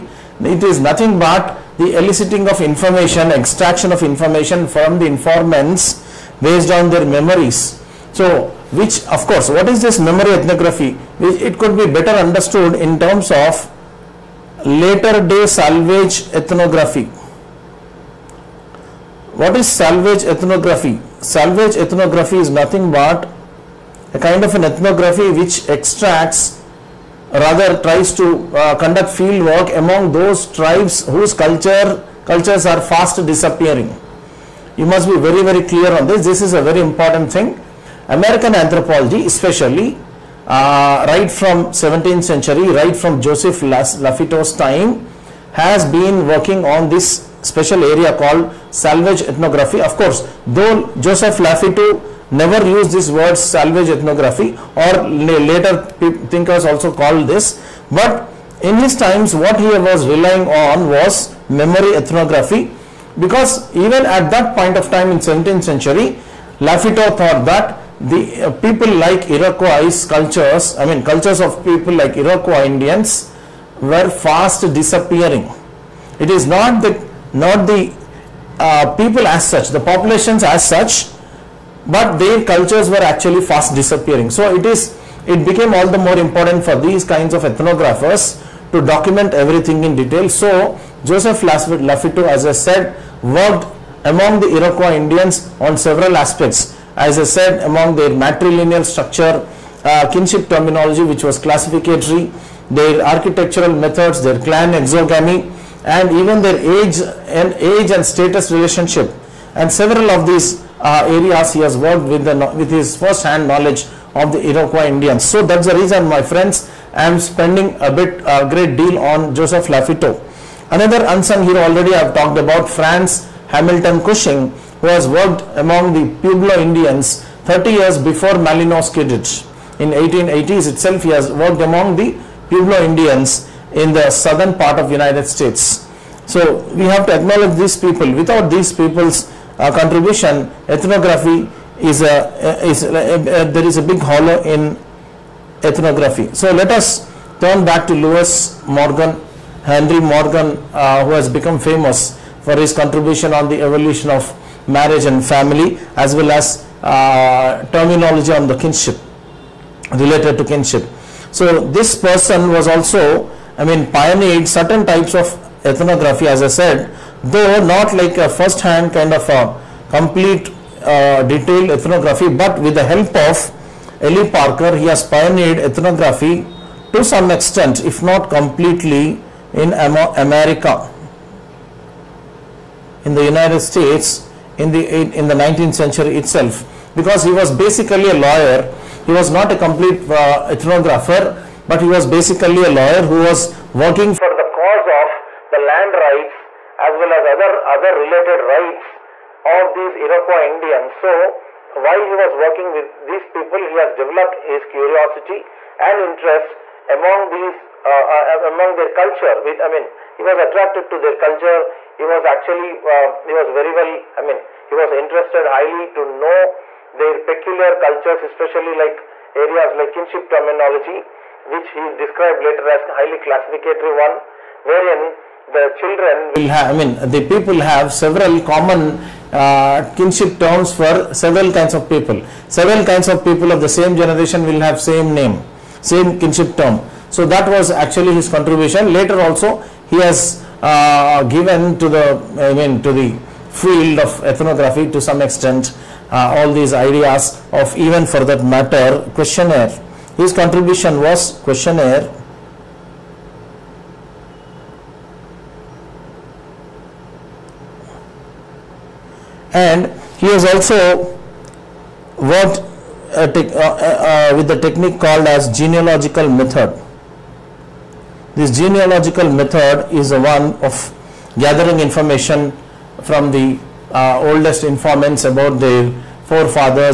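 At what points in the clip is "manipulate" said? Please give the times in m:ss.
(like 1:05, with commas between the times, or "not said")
not said.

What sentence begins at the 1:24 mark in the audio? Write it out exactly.
So it is it became all the more important for these kinds of ethnographers to document everything in detail.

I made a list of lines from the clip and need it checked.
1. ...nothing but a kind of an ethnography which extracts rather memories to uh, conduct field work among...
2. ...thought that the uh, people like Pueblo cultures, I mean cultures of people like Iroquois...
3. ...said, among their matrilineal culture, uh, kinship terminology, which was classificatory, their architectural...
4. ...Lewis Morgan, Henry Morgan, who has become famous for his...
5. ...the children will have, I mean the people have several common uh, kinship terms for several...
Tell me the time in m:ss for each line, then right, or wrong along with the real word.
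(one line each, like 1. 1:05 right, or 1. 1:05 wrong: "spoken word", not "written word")
1. 0:22 wrong: "tries", not "memories"
2. 1:07 wrong: "Iroquois", not "Pueblo"
3. 1:37 wrong: "structure", not "culture"
4. 2:27 right
5. 3:45 right.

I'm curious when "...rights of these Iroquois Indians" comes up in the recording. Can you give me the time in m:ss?
3:18.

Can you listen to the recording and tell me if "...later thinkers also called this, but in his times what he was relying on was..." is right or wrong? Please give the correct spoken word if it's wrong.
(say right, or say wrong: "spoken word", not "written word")
right.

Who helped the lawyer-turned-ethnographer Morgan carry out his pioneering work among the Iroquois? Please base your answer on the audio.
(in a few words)
Eli Parker.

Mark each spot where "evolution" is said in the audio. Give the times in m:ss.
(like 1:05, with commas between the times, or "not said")
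2:33.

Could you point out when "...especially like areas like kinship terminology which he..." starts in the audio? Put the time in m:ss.
3:38.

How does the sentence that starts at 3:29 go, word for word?
With I mean, he was attracted to their culture.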